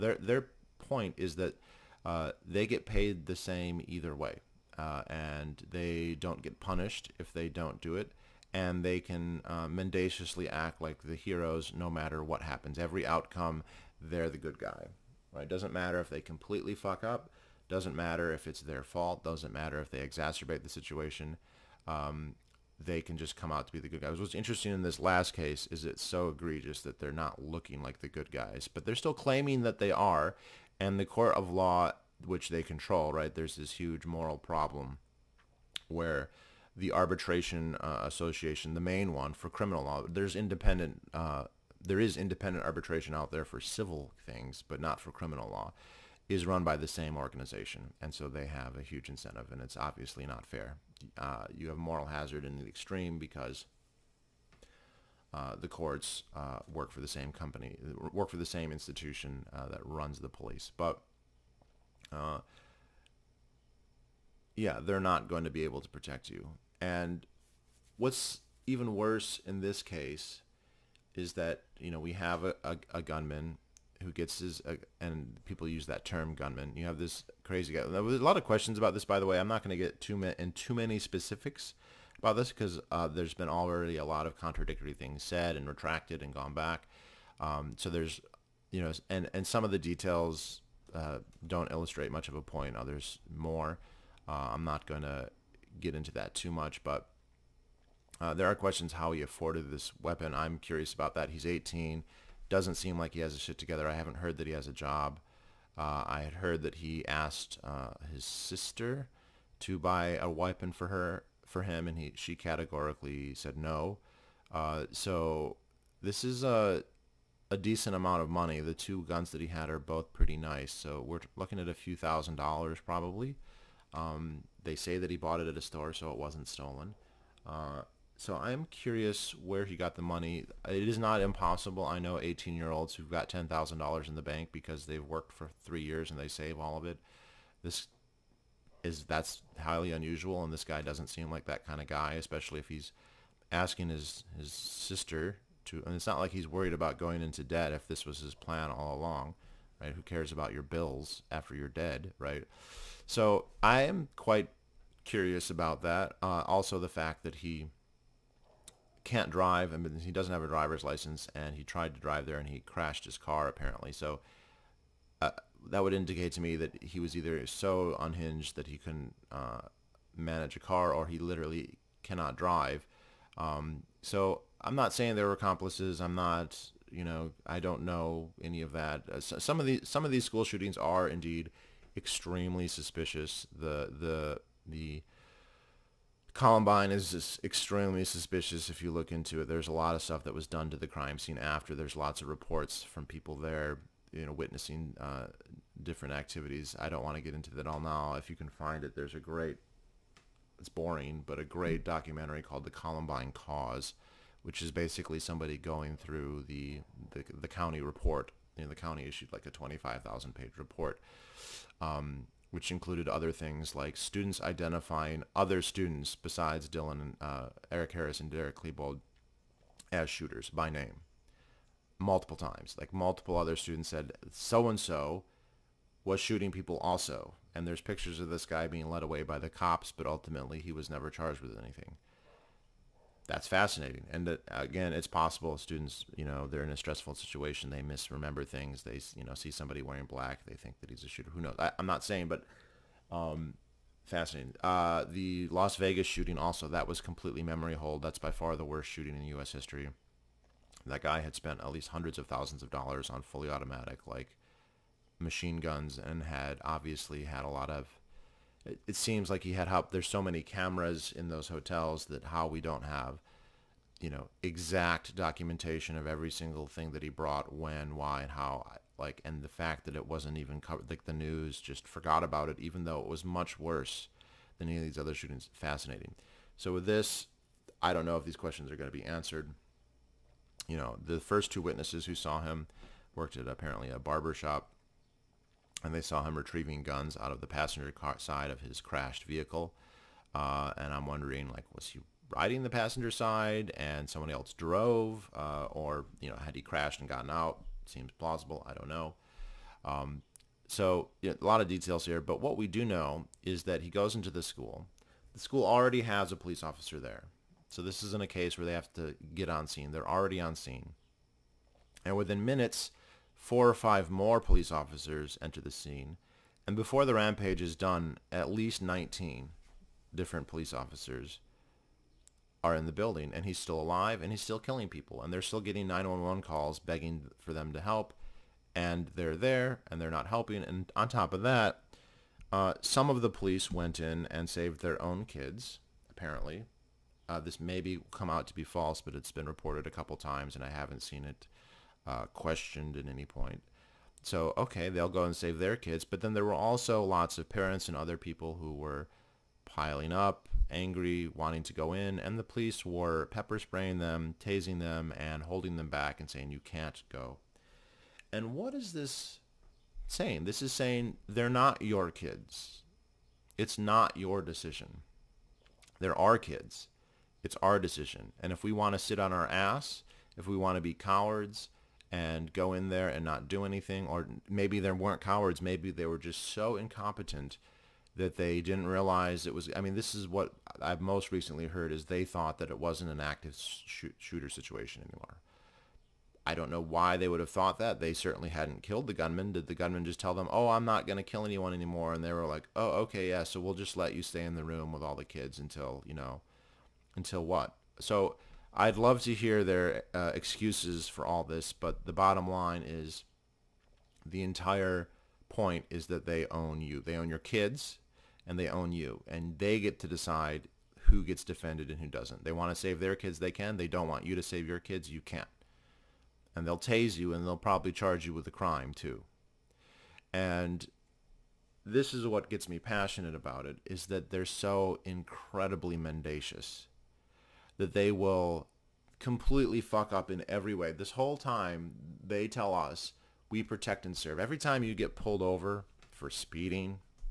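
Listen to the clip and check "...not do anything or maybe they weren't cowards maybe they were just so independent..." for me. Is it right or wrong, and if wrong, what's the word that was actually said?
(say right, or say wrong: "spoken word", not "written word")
wrong: "incompetent", not "independent".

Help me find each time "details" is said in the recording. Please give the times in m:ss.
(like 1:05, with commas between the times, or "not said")
1:29, 5:01.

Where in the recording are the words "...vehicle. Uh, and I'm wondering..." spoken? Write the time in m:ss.
4:49.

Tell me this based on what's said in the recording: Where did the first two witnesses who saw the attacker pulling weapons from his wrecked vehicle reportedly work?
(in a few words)
barber shop.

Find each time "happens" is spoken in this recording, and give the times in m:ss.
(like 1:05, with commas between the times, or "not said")
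0:12.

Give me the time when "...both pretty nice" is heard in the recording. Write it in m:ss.
1:59.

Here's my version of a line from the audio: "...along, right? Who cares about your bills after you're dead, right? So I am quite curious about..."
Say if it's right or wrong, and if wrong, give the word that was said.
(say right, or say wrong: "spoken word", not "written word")
right.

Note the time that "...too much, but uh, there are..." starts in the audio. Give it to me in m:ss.
1:36.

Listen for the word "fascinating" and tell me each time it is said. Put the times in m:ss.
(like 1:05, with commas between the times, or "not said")
3:53, 4:04, 4:35.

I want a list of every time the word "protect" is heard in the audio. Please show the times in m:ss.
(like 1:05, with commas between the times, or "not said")
1:05, 7:13.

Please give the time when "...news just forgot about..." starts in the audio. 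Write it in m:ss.
4:31.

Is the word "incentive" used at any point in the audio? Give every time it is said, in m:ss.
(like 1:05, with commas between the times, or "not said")
0:49.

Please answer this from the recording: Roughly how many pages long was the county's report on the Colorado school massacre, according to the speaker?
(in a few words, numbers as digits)
25,000.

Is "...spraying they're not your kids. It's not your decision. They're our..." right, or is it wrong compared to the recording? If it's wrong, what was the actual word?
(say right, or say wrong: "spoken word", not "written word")
wrong: "saying", not "spraying".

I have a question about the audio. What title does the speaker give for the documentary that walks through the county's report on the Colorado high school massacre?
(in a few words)
The Columbine Cause.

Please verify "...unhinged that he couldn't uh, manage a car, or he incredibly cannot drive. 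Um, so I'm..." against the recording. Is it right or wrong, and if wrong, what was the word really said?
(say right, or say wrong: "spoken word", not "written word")
wrong: "literally", not "incredibly".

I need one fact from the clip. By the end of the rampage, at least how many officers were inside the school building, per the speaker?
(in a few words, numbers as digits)
19.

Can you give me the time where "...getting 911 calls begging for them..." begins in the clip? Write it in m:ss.
5:25.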